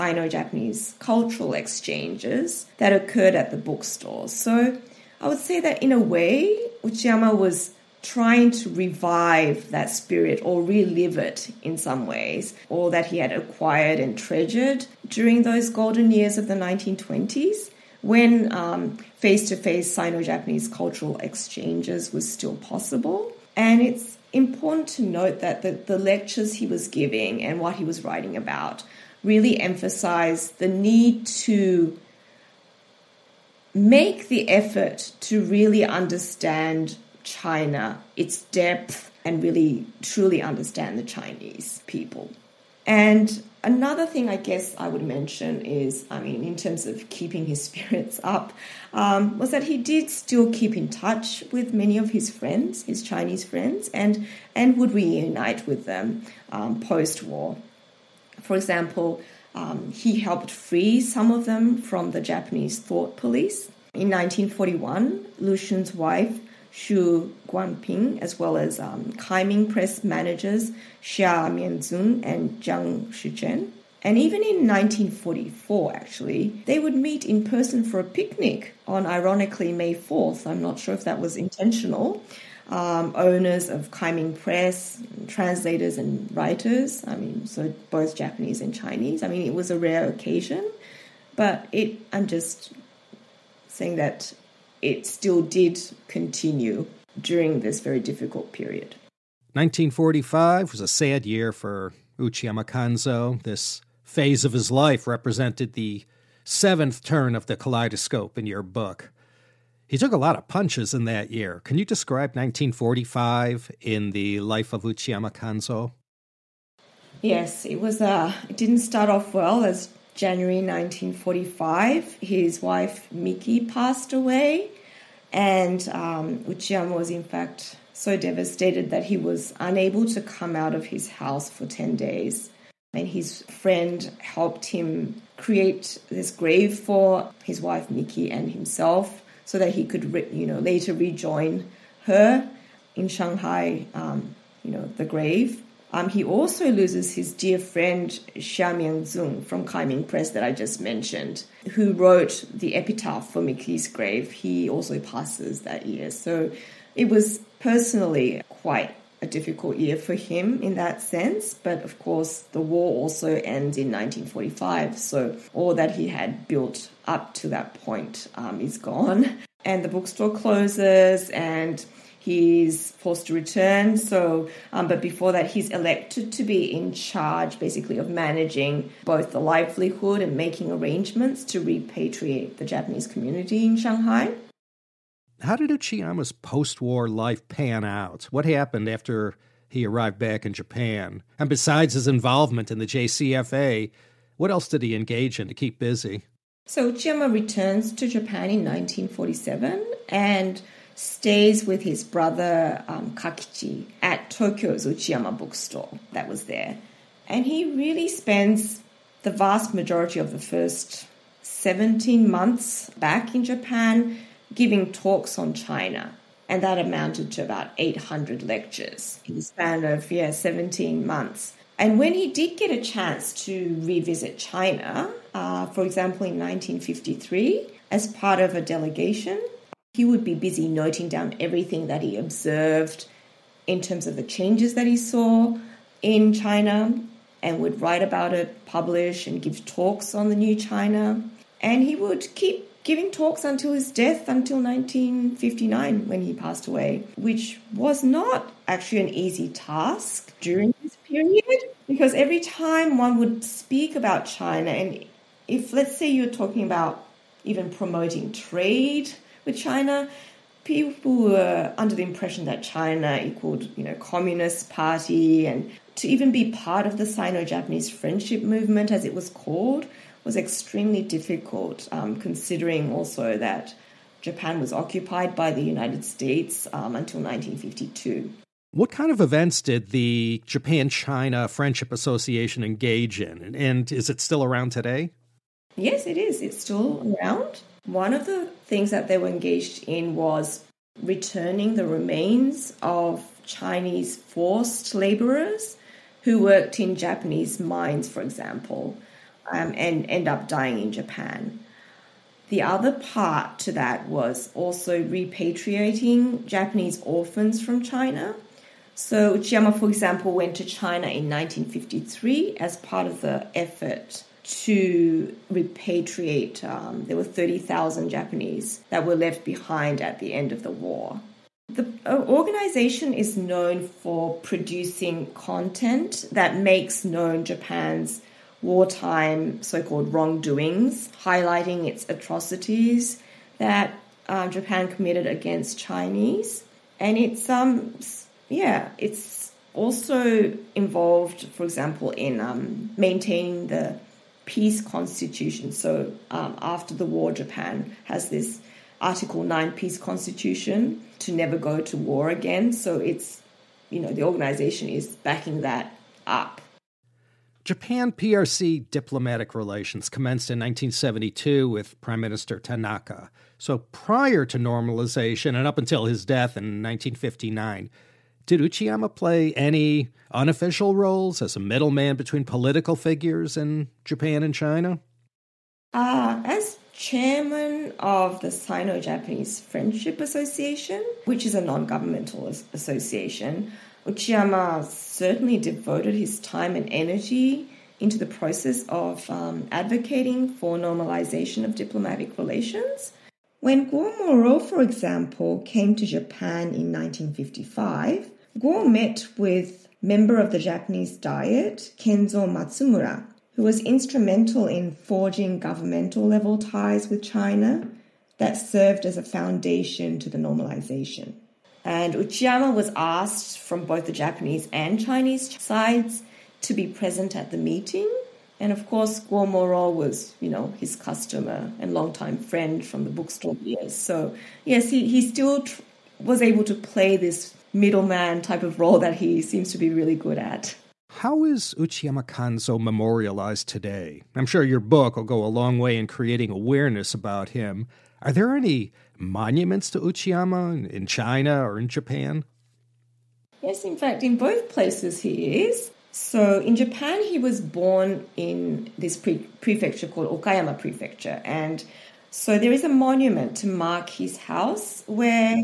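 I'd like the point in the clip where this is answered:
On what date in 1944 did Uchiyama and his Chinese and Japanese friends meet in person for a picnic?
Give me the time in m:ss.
1:19.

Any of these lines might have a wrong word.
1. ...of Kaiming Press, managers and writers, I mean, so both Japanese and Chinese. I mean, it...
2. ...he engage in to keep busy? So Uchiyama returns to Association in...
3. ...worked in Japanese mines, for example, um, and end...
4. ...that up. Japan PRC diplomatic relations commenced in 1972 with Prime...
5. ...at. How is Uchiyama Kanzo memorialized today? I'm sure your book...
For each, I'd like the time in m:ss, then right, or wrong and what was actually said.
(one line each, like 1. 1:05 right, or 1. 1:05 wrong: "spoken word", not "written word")
1. 1:23 wrong: "translators", not "managers"
2. 3:14 wrong: "Japan", not "Association"
3. 4:56 right
4. 5:55 right
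5. 7:10 right.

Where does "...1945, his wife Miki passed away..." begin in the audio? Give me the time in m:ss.
2:00.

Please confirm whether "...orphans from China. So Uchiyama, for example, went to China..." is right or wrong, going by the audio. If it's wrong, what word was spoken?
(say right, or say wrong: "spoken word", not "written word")
right.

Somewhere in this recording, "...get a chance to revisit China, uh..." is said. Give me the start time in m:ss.
3:42.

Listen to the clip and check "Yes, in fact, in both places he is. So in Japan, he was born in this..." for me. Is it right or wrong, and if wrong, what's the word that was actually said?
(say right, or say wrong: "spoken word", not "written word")
right.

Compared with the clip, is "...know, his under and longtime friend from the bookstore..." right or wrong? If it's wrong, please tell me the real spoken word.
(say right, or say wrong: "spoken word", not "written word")
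wrong: "customer", not "under".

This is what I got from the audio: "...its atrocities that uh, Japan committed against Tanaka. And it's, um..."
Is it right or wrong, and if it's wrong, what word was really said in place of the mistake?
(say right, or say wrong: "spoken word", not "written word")
wrong: "Chinese", not "Tanaka".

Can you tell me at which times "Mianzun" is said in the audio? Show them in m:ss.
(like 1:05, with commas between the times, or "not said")
1:11, 2:28.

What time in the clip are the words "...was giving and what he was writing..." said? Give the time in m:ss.
0:26.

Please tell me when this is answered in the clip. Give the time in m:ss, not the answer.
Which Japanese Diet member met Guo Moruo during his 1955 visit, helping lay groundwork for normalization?
6:41.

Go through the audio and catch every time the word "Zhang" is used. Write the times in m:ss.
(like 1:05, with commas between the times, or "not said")
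1:12.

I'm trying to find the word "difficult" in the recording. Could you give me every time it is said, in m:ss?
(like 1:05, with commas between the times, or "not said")
1:38, 2:39, 4:31.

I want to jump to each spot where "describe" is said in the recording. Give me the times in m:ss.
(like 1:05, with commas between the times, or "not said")
1:51.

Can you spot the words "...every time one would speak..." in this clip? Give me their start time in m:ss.
4:12.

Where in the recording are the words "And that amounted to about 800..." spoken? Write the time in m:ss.
3:36.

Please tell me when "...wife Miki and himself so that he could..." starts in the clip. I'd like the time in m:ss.
2:17.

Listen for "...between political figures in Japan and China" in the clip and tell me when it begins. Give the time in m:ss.
6:12.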